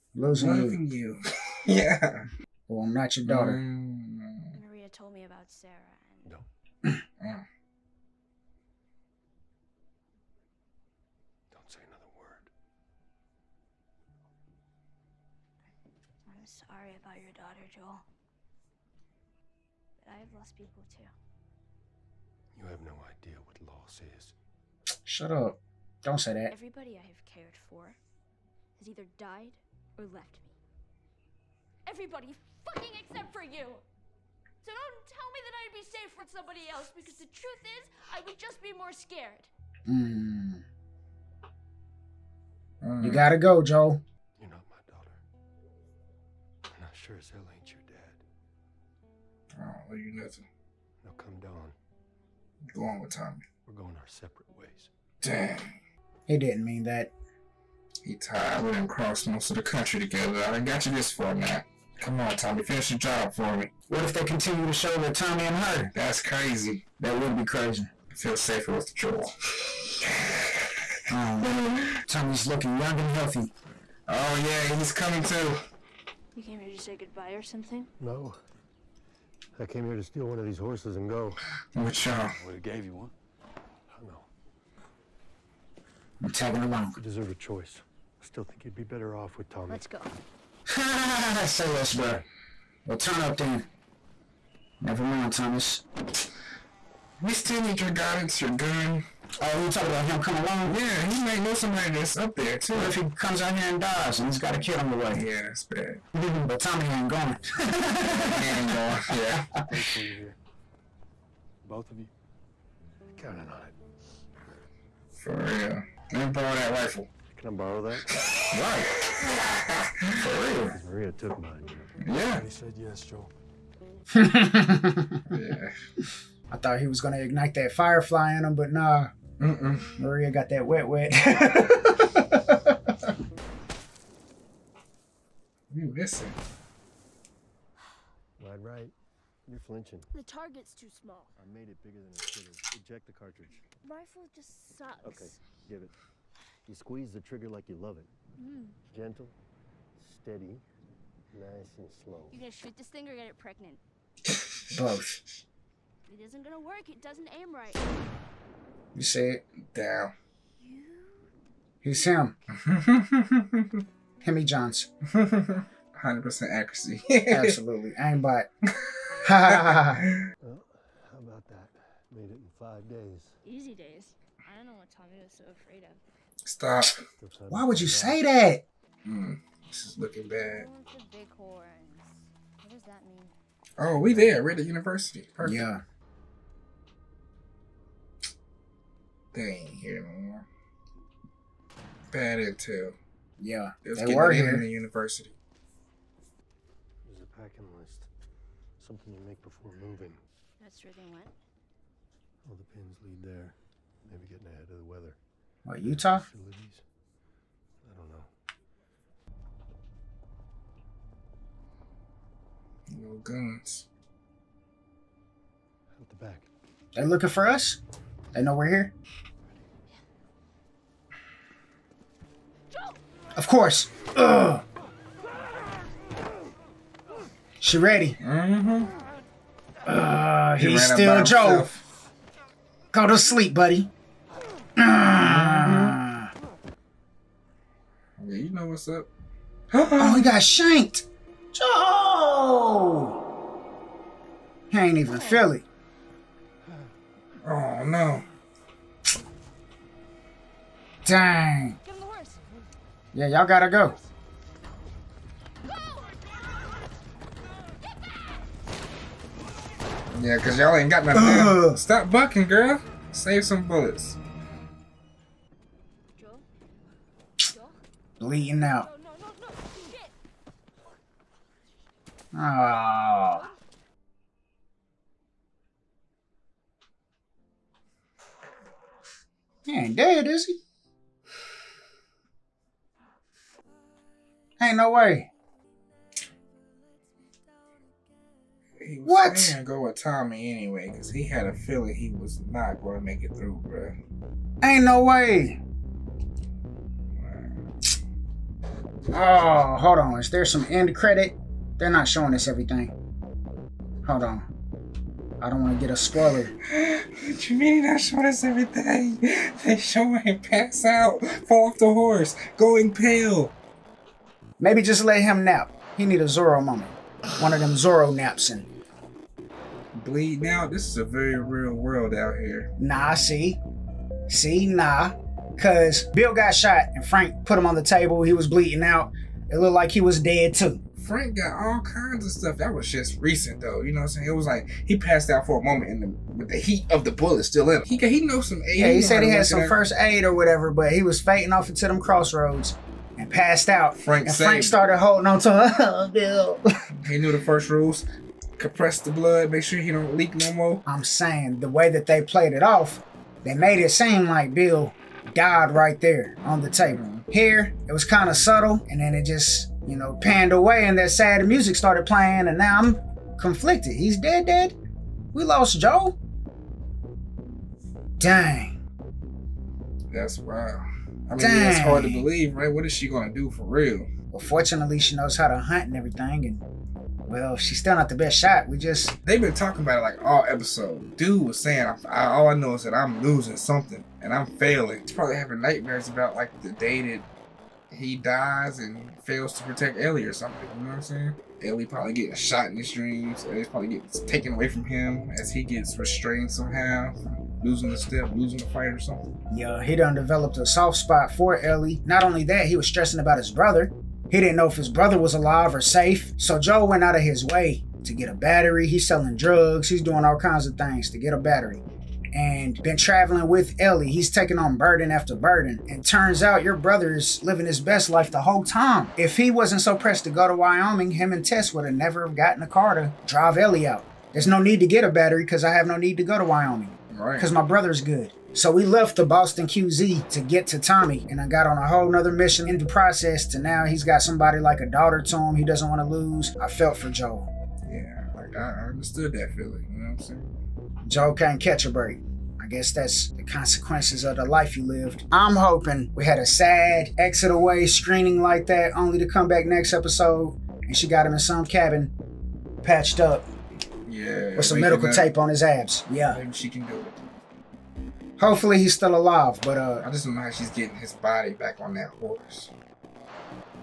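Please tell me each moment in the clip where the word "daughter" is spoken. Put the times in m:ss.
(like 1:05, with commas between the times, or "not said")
0:03, 0:17, 7:14.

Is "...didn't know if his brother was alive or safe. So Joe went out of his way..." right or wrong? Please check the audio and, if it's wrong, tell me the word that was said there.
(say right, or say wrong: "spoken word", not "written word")
right.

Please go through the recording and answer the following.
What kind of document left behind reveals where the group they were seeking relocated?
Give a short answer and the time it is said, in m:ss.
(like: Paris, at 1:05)
A packing list, at 3:17.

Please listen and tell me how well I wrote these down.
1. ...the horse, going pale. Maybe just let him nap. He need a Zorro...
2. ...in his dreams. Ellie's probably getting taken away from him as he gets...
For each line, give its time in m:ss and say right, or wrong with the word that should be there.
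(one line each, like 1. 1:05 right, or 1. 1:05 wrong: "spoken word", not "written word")
1. 5:11 right
2. 6:32 right.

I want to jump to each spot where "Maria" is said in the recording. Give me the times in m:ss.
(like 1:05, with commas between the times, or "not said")
0:04, 2:00, 2:09.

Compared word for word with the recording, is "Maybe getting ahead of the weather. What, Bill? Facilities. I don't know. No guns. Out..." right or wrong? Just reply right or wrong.
wrong.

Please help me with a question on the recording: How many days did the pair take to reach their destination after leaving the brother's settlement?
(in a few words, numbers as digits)
5.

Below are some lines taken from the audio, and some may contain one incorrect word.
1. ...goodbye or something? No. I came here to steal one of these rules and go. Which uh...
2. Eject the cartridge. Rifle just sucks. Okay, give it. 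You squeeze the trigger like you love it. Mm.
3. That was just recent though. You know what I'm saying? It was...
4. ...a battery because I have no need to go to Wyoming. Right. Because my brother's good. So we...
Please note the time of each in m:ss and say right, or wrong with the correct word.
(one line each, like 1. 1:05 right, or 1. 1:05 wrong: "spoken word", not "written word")
1. 1:16 wrong: "horses", not "rules"
2. 2:22 right
3. 5:32 right
4. 7:05 right.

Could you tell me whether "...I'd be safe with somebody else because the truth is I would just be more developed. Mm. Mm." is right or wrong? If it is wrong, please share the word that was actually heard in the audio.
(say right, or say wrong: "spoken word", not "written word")
wrong: "scared", not "developed".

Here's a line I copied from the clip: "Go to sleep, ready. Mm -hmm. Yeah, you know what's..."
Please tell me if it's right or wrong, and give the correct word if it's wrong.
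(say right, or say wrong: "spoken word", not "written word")
wrong: "buddy", not "ready".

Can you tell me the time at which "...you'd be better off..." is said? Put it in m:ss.
1:28.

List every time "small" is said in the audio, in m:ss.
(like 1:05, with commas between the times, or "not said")
2:20.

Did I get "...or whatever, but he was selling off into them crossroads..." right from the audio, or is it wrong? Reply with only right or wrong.
wrong.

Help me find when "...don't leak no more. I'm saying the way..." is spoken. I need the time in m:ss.
5:49.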